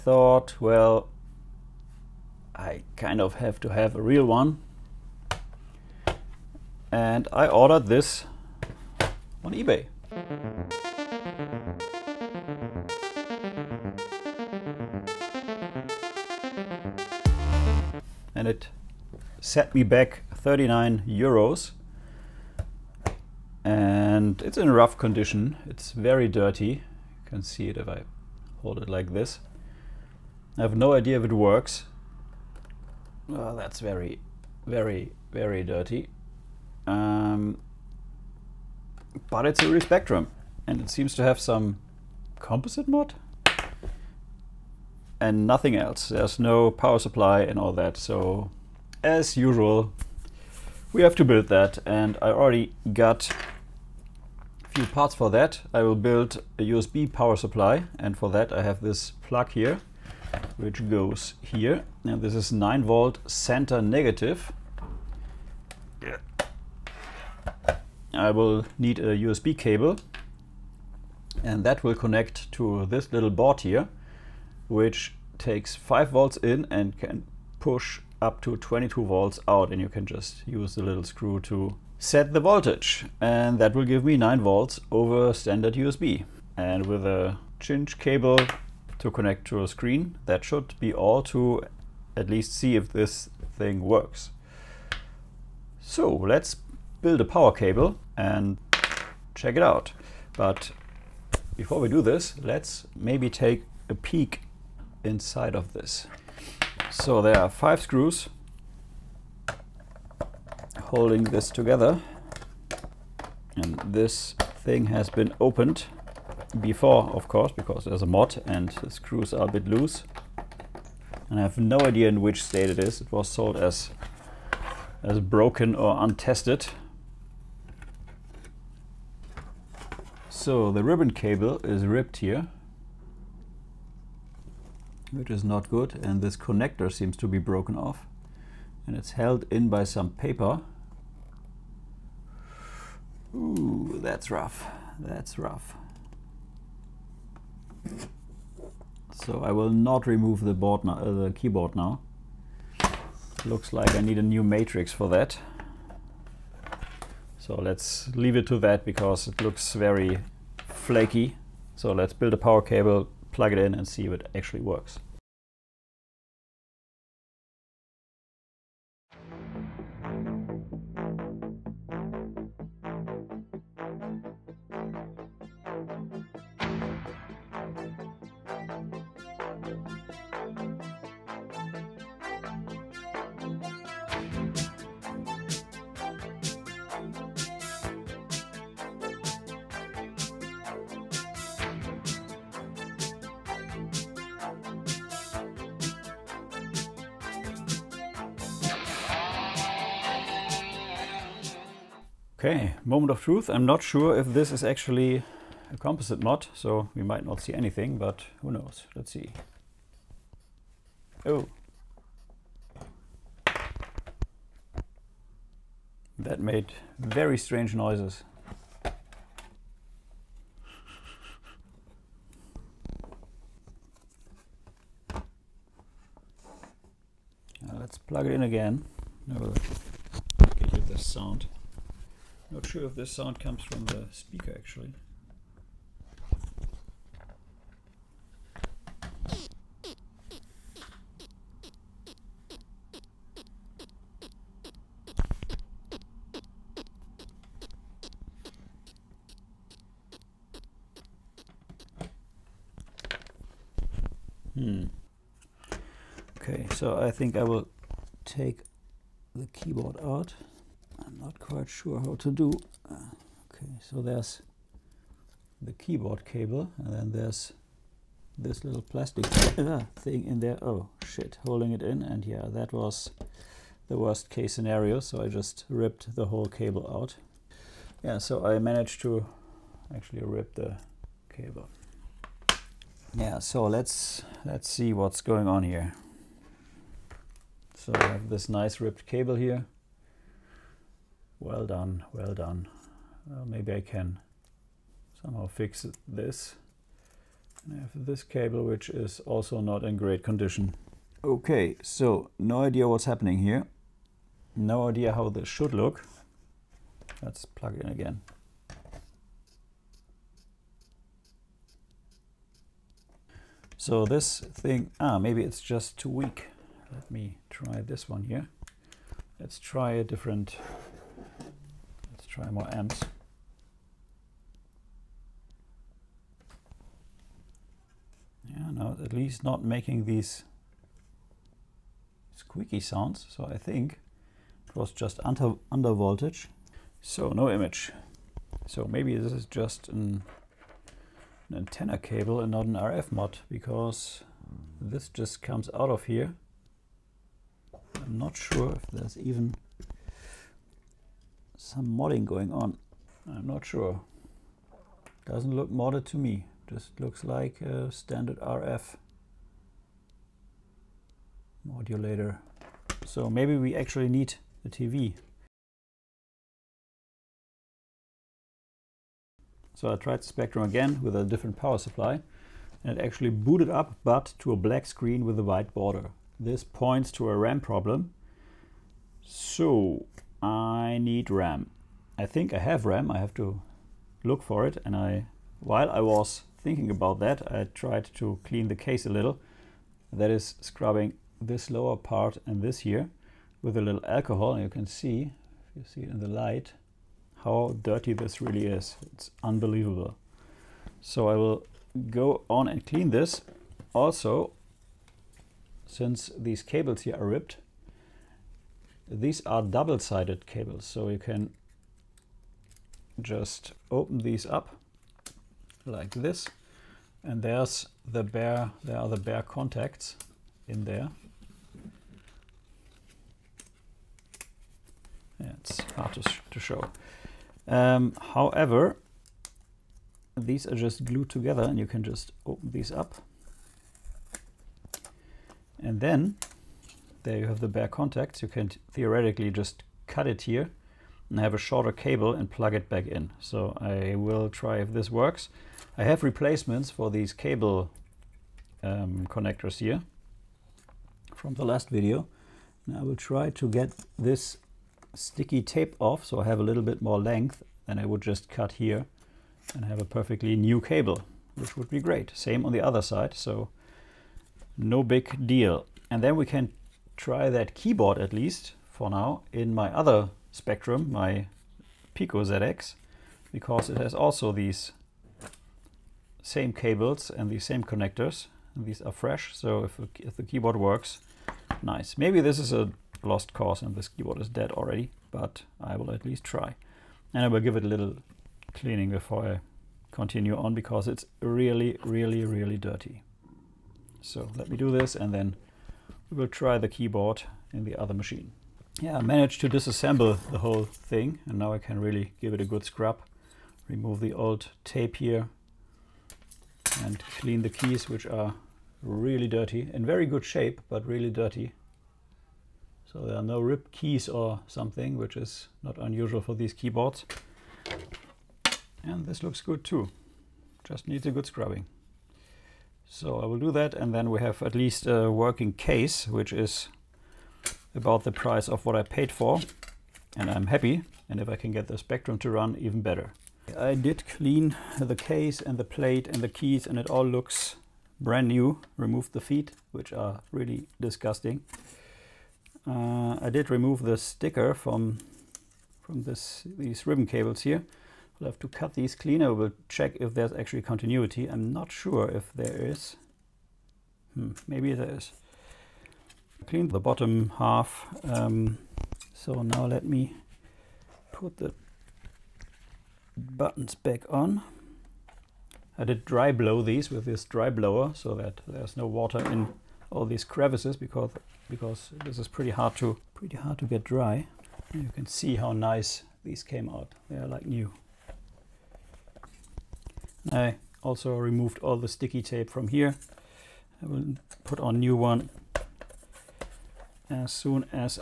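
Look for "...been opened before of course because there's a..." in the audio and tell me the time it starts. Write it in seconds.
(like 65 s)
115 s.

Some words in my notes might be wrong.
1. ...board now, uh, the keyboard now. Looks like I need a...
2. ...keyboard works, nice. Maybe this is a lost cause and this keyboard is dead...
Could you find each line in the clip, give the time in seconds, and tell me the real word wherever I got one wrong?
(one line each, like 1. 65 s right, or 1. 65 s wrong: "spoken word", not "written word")
1. 150 s right
2. 480 s right.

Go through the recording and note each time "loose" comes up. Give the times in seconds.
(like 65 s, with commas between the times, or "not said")
119 s.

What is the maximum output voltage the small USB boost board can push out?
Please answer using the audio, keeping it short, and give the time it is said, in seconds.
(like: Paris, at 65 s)
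22 volts, at 78 s.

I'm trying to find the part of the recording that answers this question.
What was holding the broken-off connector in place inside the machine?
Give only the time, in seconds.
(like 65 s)
140 s.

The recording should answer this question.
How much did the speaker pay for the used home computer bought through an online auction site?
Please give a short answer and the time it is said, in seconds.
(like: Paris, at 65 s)
39 euros, at 20 s.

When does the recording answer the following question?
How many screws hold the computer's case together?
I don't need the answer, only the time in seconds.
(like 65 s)
107 s.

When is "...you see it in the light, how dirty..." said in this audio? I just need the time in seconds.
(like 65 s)
395 s.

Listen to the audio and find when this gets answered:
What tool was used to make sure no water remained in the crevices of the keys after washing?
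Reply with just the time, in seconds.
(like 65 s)
567 s.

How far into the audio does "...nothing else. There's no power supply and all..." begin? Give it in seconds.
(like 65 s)
45 s.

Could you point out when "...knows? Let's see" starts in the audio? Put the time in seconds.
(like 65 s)
208 s.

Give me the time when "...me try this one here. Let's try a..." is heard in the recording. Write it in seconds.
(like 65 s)
317 s.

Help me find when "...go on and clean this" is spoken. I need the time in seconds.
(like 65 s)
402 s.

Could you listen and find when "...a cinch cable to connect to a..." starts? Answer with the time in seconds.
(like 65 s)
87 s.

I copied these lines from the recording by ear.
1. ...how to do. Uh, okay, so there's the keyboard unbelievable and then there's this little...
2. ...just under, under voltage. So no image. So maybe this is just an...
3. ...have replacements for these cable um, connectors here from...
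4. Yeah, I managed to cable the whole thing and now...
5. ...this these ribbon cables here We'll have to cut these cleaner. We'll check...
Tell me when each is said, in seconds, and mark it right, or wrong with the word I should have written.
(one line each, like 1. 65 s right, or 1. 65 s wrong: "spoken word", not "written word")
1. 261 s wrong: "cable", not "unbelievable"
2. 334 s right
3. 446 s right
4. 499 s wrong: "disassemble", not "cable"
5. 546 s right.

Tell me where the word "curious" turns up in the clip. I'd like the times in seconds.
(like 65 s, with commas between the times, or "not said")
not said.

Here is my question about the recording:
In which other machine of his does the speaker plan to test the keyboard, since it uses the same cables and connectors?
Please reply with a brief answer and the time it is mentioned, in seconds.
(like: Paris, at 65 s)
Pico ZX, at 472 s.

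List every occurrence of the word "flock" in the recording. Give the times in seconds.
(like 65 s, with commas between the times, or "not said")
not said.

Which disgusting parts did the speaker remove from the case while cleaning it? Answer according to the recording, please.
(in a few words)
The feet.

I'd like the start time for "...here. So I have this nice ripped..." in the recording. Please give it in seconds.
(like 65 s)
285 s.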